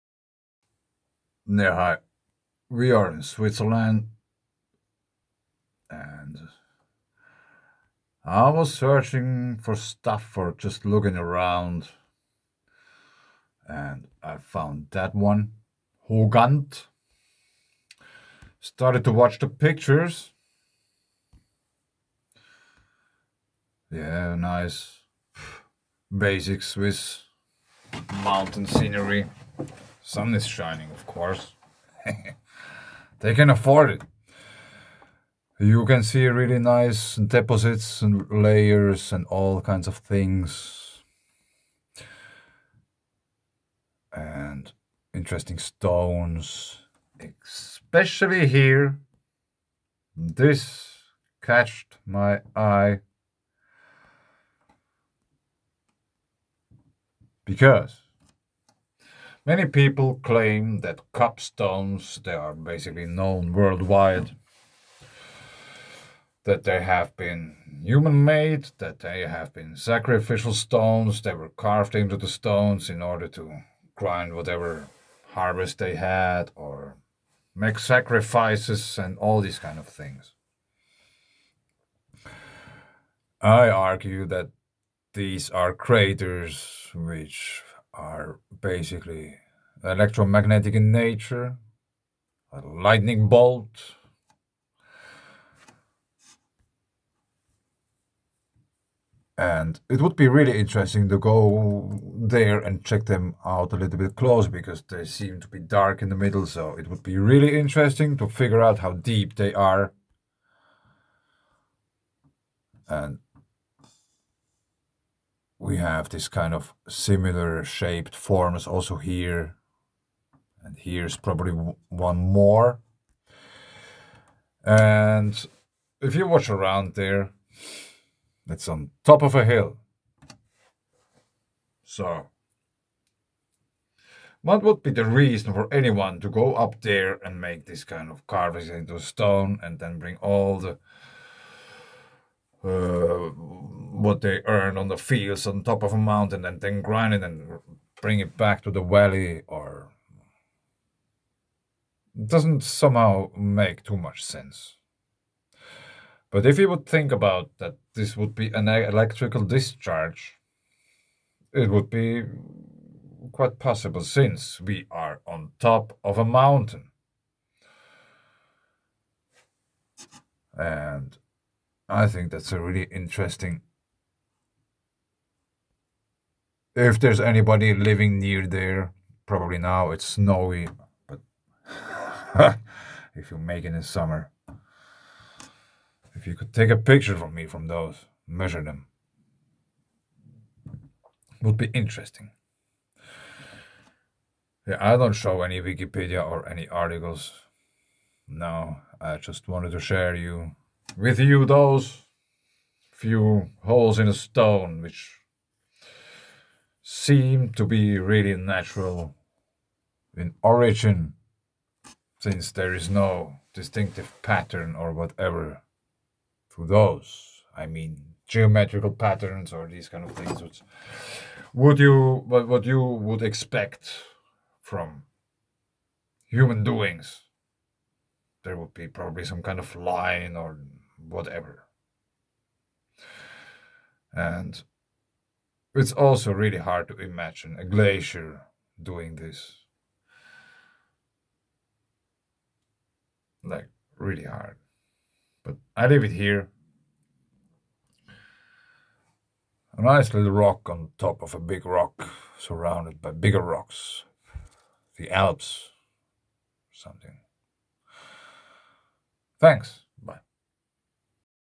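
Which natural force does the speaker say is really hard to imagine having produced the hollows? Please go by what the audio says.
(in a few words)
A glacier.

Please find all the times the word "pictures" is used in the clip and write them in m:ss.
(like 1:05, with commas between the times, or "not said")
0:19, 3:06.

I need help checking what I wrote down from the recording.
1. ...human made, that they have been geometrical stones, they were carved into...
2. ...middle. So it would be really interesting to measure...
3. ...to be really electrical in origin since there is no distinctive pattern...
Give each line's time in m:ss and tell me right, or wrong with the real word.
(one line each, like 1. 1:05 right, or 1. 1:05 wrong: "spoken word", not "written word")
1. 1:07 wrong: "sacrificial", not "geometrical"
2. 1:46 wrong: "figure", not "measure"
3. 3:27 wrong: "natural", not "electrical".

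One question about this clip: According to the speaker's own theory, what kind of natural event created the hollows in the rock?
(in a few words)
A lightning bolt.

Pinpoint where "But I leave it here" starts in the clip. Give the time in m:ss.
4:05.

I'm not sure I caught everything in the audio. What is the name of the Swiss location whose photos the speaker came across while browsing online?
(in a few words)
Hohgant.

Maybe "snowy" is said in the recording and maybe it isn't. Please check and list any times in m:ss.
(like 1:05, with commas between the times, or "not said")
3:00.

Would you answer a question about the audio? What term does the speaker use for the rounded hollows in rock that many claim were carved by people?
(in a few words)
cupstones.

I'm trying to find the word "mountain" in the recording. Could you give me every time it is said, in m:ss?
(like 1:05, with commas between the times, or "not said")
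0:28, 2:25, 2:46.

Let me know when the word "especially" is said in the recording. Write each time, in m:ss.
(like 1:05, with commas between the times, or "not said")
0:47.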